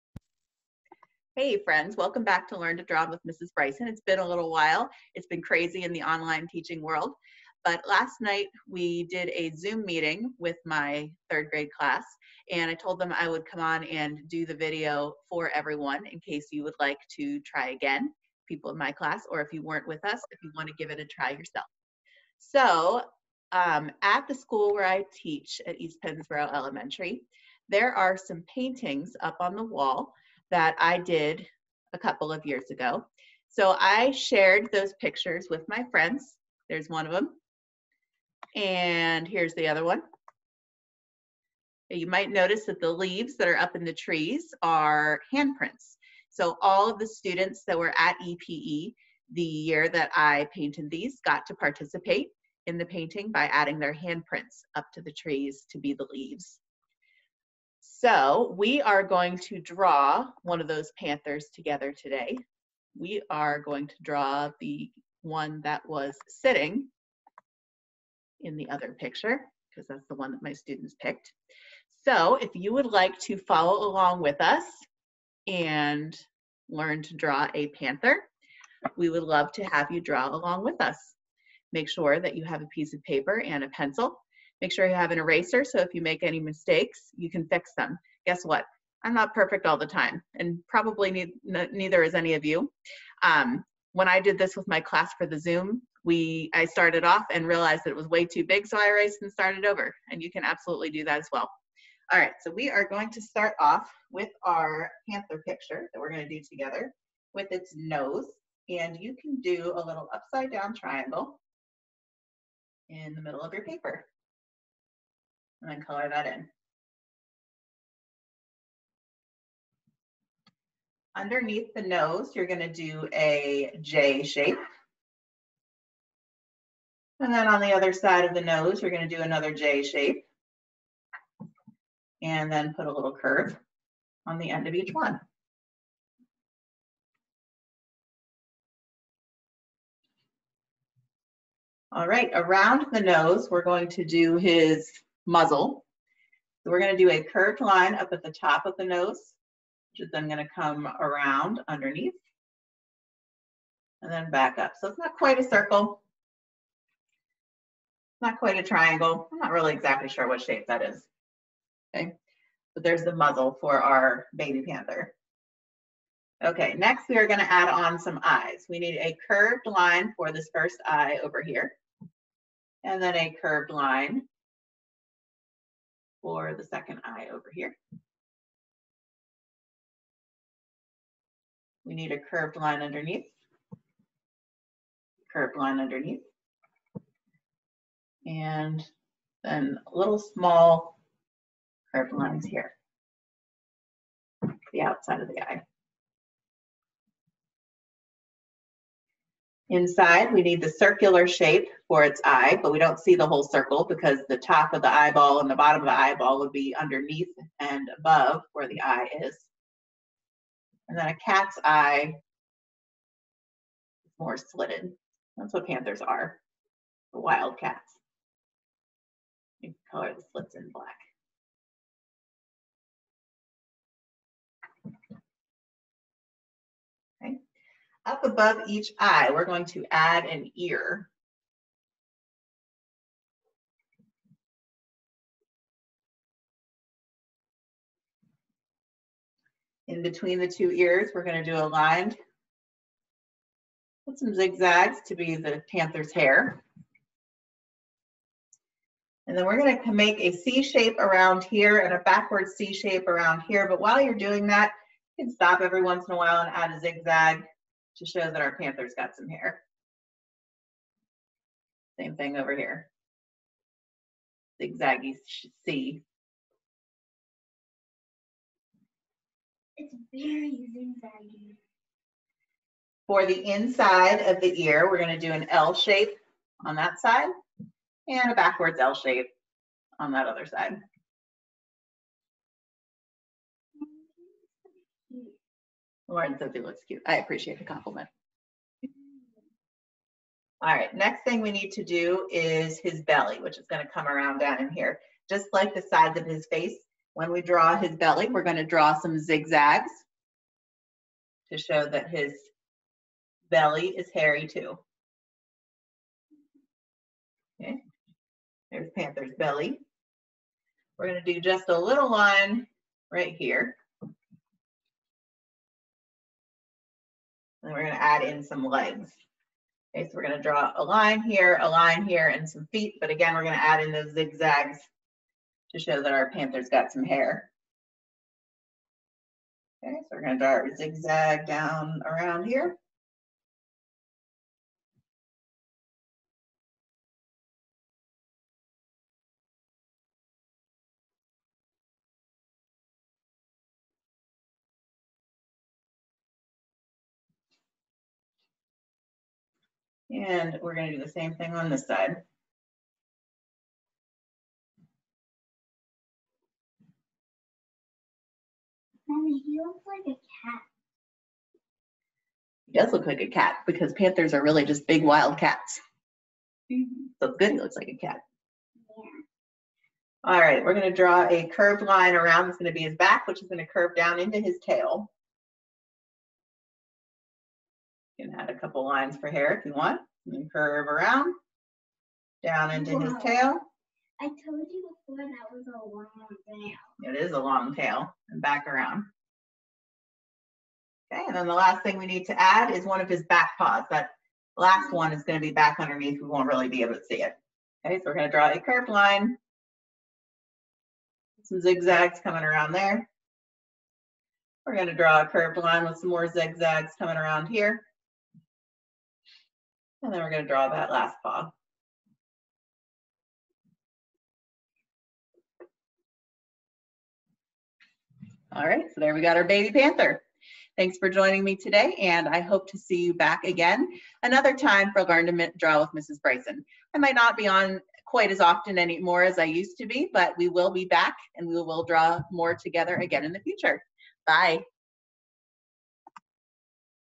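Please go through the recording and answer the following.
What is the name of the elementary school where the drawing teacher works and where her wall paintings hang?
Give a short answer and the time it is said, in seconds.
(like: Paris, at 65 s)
East Pennsboro Elementary, at 25 s.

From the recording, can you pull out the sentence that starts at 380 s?
And curve around, down into wow.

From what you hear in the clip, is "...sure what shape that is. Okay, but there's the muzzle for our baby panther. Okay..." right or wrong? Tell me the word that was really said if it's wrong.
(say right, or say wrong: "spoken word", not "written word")
right.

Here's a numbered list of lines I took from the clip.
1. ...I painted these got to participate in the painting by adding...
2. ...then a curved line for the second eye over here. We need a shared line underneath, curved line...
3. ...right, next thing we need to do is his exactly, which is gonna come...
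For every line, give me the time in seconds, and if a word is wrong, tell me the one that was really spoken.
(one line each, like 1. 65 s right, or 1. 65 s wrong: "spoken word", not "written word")
1. 50 s right
2. 173 s wrong: "curved", not "shared"
3. 290 s wrong: "belly", not "exactly".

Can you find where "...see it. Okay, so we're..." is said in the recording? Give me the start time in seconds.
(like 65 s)
397 s.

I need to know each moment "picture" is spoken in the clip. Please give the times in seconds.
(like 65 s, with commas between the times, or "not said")
35 s, 68 s, 105 s.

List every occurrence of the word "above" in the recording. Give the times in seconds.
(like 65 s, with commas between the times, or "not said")
207 s, 228 s.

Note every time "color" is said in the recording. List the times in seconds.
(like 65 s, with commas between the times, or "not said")
115 s, 219 s.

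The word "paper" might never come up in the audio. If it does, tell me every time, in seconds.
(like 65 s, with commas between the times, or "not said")
83 s, 113 s.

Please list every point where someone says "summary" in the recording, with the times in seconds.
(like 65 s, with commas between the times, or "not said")
not said.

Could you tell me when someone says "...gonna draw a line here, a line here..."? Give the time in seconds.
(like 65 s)
320 s.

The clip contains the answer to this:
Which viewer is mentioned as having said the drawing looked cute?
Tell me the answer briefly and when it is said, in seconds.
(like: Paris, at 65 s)
Lauren, at 286 s.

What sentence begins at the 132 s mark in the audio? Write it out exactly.
And then put a little curve on the end of each one.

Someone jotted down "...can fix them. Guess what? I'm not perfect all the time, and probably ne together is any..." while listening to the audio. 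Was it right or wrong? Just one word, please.
wrong.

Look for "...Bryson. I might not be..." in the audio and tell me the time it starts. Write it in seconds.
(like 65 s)
426 s.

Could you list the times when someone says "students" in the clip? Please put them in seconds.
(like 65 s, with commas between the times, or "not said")
47 s, 70 s.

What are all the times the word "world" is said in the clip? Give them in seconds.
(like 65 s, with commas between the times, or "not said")
6 s.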